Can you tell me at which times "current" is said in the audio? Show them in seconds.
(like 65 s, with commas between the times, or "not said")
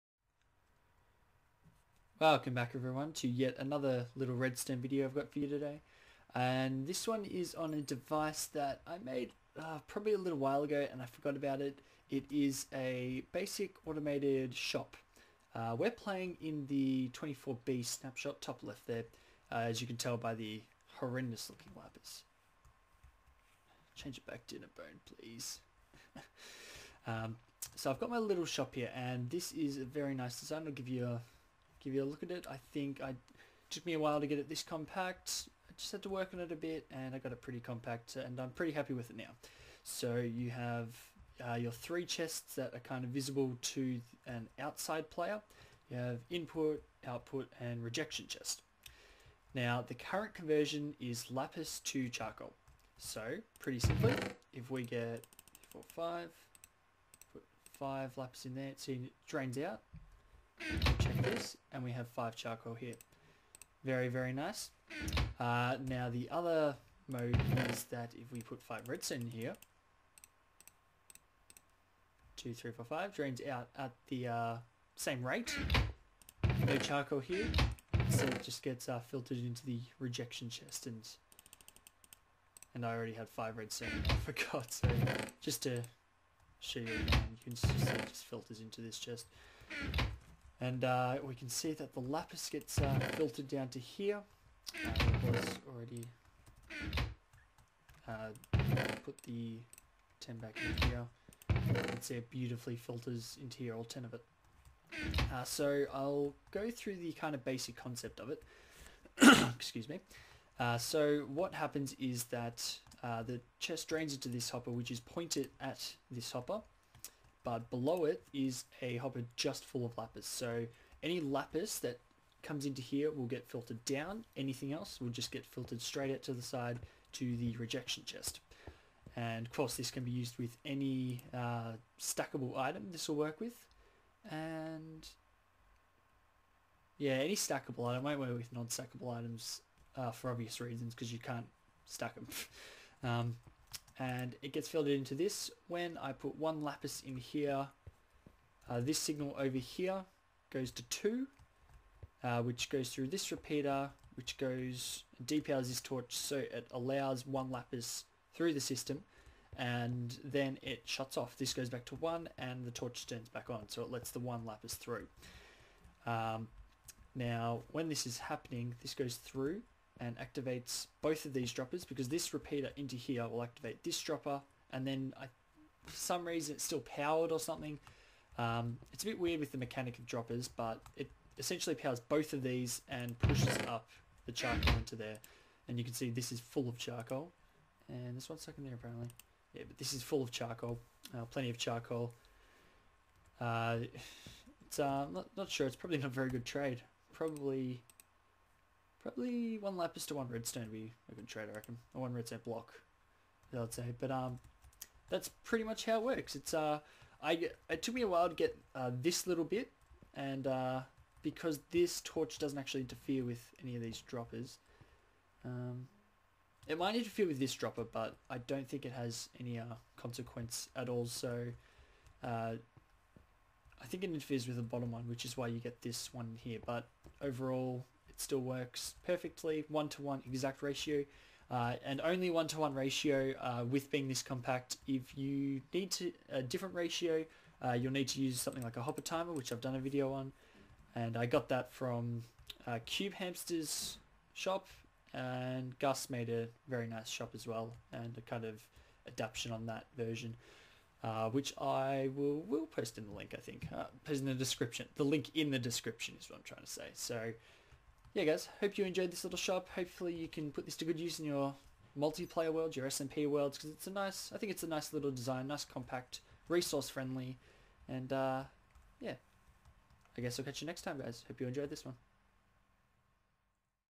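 49 s.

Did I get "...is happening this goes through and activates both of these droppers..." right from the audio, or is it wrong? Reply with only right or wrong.
right.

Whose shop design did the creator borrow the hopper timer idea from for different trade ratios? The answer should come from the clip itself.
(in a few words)
CubeHamster.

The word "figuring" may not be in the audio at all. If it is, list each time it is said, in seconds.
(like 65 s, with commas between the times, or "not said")
not said.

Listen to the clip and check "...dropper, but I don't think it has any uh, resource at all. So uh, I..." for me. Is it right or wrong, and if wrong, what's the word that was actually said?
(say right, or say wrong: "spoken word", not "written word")
wrong: "consequence", not "resource".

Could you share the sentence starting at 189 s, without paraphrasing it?
Yeah but this is full of charcoal, uh, plenty of charcoal.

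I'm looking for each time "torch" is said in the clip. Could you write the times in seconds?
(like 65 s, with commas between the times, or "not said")
155 s, 162 s, 212 s.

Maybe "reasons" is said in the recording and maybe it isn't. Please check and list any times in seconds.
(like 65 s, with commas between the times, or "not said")
140 s, 176 s.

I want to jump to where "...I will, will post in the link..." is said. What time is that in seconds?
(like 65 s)
251 s.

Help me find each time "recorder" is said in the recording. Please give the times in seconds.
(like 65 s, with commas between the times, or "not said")
not said.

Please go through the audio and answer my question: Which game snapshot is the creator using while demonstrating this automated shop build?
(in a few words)
24B snapshot.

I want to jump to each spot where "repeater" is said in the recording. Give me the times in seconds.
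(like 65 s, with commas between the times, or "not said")
153 s, 172 s.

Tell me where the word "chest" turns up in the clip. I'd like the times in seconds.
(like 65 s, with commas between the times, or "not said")
42 s, 48 s, 80 s, 88 s, 113 s, 128 s.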